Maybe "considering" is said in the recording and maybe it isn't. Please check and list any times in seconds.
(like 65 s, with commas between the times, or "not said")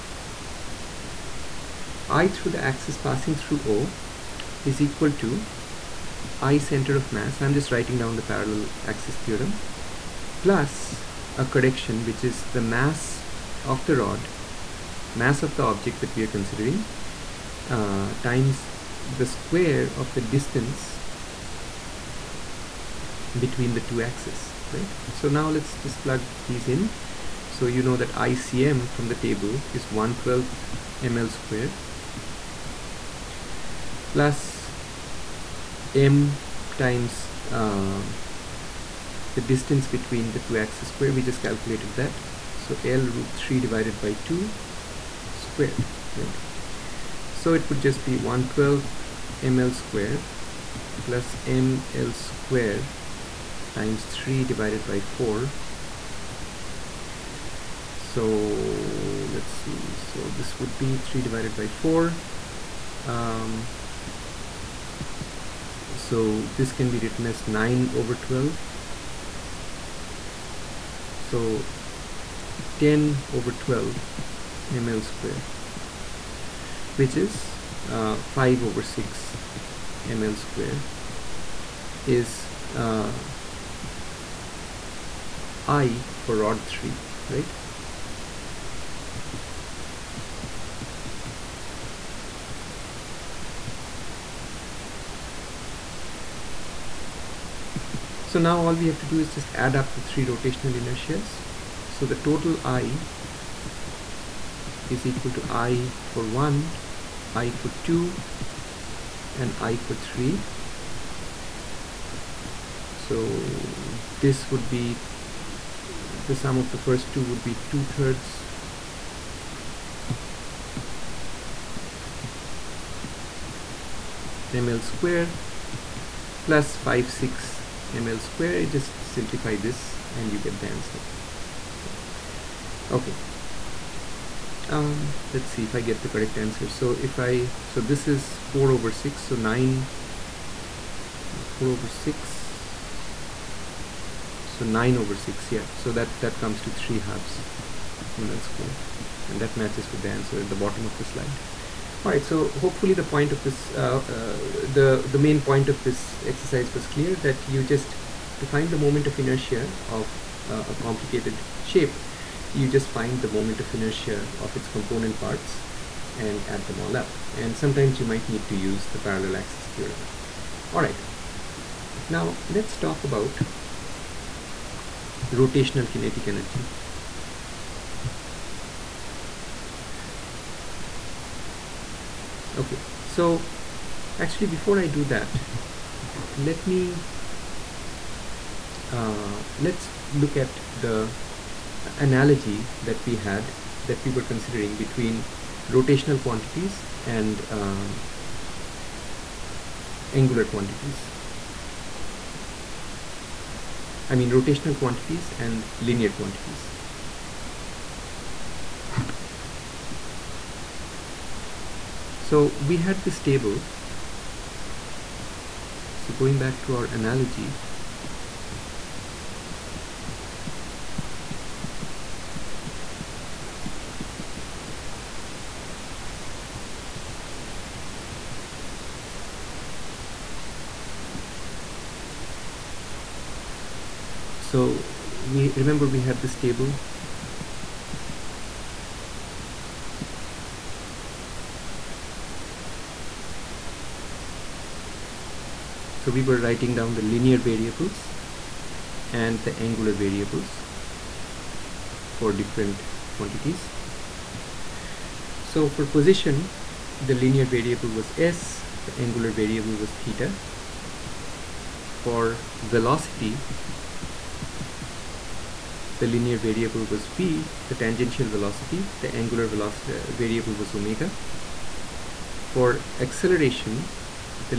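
16 s, 194 s.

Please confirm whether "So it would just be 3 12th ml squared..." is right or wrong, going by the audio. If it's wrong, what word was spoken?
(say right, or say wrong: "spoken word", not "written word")
wrong: "1", not "3".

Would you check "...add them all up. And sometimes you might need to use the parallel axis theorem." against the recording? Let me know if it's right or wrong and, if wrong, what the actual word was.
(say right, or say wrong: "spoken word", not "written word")
right.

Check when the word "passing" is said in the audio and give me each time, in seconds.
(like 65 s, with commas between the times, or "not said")
2 s.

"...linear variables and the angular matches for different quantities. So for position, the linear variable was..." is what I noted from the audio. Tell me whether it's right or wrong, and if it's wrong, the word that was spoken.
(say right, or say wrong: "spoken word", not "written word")
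wrong: "variables", not "matches".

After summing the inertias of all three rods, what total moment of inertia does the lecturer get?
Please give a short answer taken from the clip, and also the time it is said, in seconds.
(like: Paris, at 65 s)
3/2 ML^2, at 146 s.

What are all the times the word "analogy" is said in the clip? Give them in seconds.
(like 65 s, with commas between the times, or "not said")
191 s, 216 s.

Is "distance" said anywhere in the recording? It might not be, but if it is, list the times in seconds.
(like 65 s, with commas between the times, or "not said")
20 s, 39 s.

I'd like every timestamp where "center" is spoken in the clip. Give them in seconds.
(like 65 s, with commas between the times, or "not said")
6 s.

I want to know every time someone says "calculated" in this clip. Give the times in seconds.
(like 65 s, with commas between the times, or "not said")
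41 s.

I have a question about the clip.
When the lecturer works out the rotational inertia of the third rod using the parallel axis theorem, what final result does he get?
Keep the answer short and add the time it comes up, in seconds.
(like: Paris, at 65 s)
5/6 ML^2, at 78 s.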